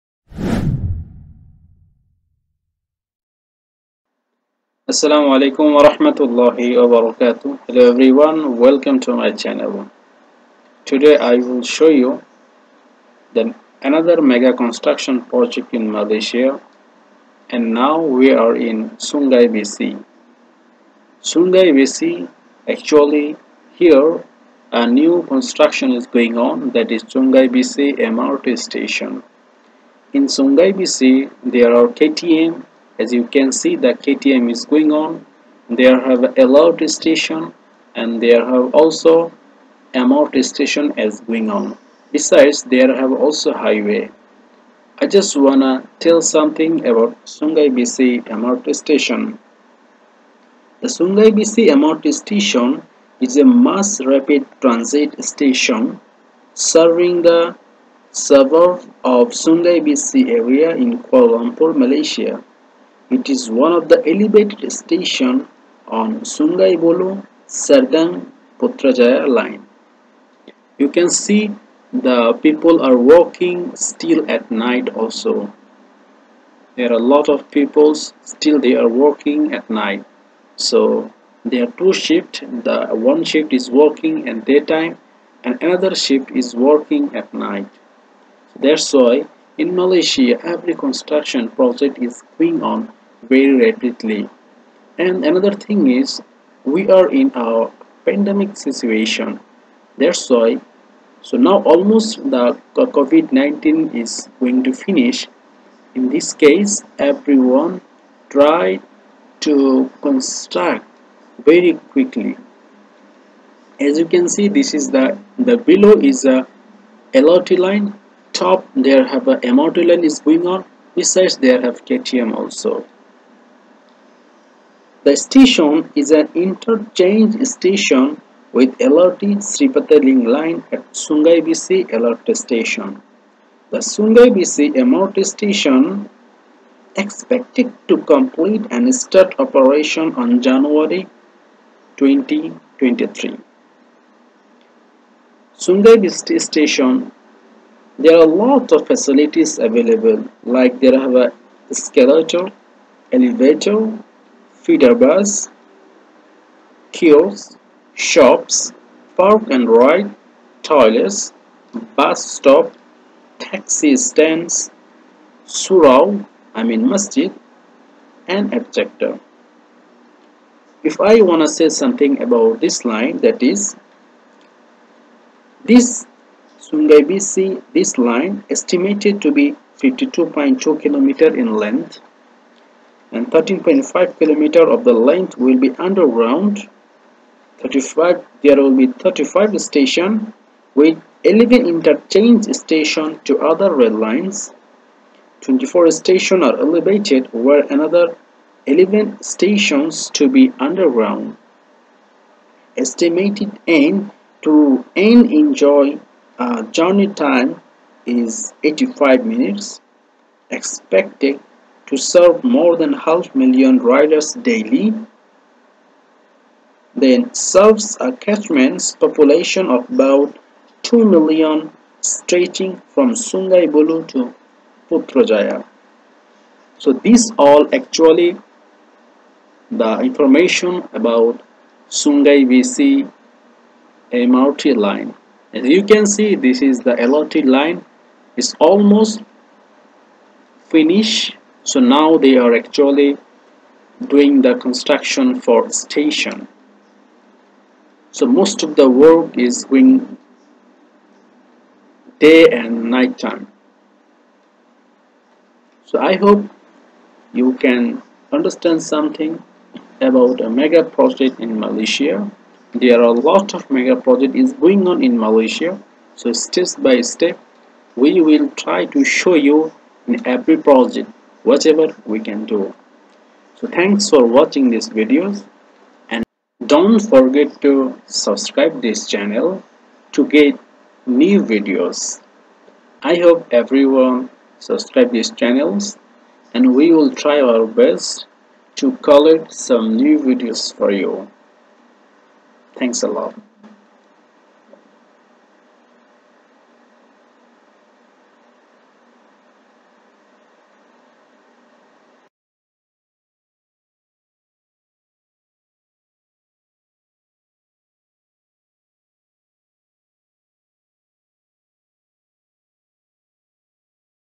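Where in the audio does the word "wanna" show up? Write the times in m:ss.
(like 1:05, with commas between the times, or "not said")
0:45, 2:51.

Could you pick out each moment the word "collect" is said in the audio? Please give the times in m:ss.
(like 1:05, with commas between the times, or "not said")
4:48.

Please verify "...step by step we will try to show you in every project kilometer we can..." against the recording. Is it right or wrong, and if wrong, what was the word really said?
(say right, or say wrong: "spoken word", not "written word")
wrong: "whatever", not "kilometer".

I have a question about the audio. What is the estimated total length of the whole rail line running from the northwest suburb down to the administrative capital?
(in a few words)
52.2 km.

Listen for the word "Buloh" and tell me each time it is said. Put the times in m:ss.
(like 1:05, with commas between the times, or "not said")
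3:43.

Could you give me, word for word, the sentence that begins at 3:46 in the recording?
So these all actually the information about Sungai Besi MRT line.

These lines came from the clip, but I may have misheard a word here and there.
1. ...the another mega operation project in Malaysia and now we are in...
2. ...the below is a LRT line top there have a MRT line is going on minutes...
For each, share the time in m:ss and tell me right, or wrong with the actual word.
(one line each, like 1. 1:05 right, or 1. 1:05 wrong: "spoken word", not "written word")
1. 0:13 wrong: "construction", not "operation"
2. 1:55 wrong: "besides", not "minutes".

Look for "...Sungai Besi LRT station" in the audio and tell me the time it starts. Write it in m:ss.
2:10.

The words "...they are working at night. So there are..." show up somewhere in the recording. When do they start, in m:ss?
1:18.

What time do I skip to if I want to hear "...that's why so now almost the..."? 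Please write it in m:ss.
1:39.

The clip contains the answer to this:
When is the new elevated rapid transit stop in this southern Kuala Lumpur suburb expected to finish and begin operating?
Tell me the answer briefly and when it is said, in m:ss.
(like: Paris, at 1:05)
January 2023, at 2:20.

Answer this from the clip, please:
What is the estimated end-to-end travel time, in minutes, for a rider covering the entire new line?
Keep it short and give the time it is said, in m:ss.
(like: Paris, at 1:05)
85 minutes, at 3:28.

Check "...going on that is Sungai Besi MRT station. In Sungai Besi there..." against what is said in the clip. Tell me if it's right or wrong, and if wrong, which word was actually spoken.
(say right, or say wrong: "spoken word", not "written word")
right.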